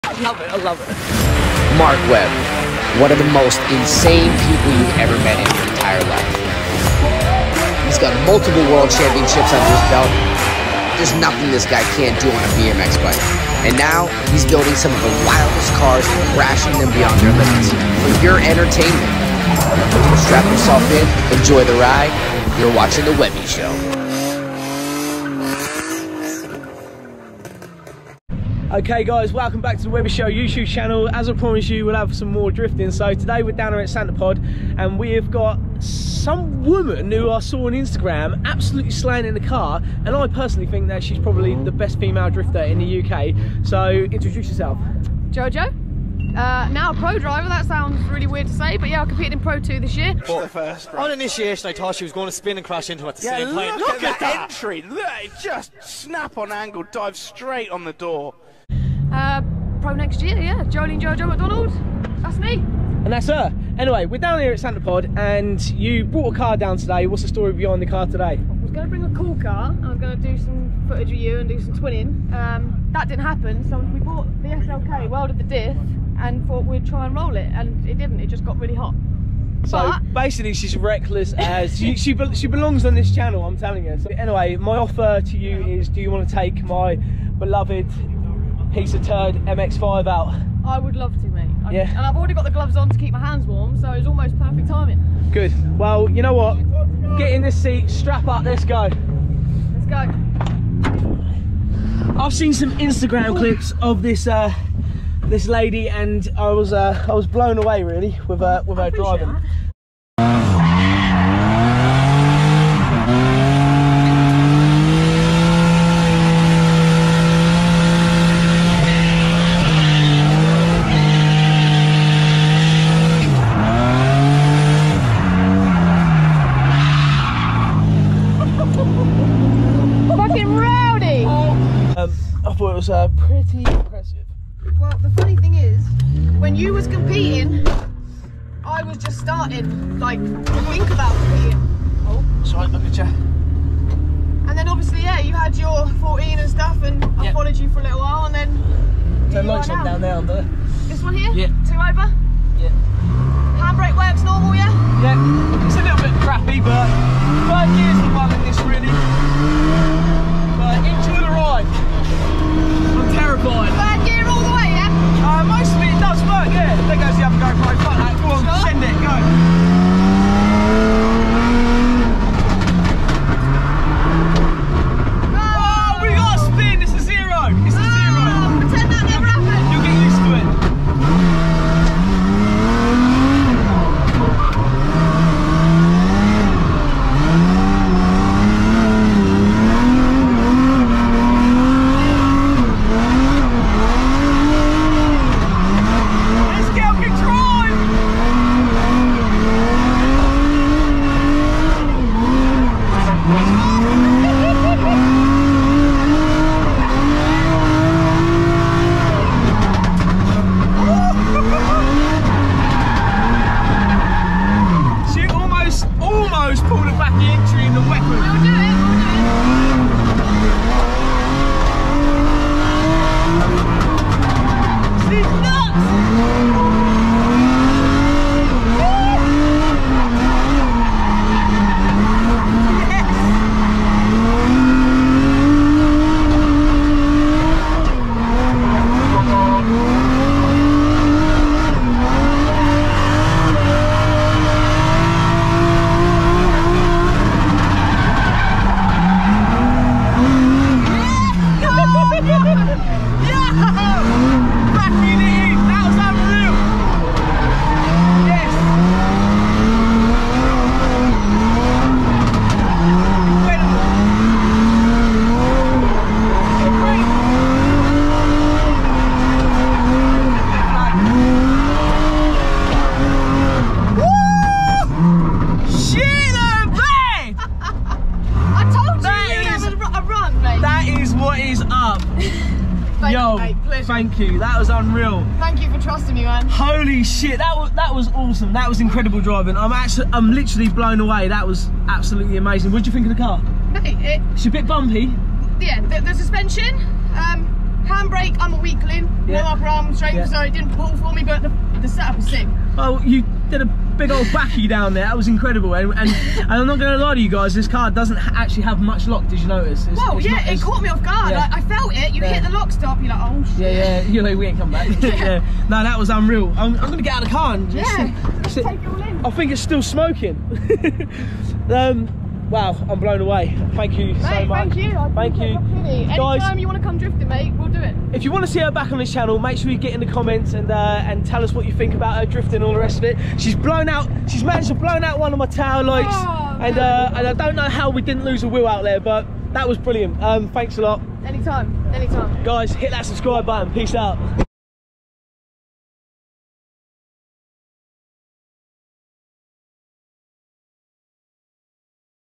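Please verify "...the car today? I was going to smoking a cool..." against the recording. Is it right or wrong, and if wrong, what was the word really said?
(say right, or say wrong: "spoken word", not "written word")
wrong: "bring", not "smoking".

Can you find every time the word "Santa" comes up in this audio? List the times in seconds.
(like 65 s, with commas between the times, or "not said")
33 s, 64 s.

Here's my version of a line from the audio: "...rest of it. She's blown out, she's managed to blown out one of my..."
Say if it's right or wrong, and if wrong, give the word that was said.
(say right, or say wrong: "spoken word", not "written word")
right.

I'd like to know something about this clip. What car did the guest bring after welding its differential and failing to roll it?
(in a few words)
SLK.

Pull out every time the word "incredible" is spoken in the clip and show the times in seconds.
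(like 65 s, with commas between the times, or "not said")
288 s, 305 s.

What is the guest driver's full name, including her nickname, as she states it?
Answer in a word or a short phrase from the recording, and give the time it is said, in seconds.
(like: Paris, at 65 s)
Jolene Jojo McDonald, at 60 s.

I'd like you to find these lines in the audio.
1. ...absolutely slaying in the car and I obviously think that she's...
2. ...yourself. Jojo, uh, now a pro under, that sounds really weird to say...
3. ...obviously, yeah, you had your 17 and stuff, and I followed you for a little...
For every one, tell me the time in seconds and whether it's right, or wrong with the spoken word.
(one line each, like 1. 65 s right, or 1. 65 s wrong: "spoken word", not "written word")
1. 38 s wrong: "personally", not "obviously"
2. 44 s wrong: "driver", not "under"
3. 144 s wrong: "14", not "17".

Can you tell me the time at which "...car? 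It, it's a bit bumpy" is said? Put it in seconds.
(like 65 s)
293 s.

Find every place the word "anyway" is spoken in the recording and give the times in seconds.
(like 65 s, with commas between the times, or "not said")
63 s, 84 s.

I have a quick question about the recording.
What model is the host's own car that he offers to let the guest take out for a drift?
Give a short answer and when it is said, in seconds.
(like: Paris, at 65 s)
MX5, at 89 s.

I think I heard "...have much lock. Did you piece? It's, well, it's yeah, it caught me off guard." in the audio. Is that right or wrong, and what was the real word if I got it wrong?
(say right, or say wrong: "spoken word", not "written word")
wrong: "notice", not "piece".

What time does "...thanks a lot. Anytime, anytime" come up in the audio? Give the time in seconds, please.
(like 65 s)
340 s.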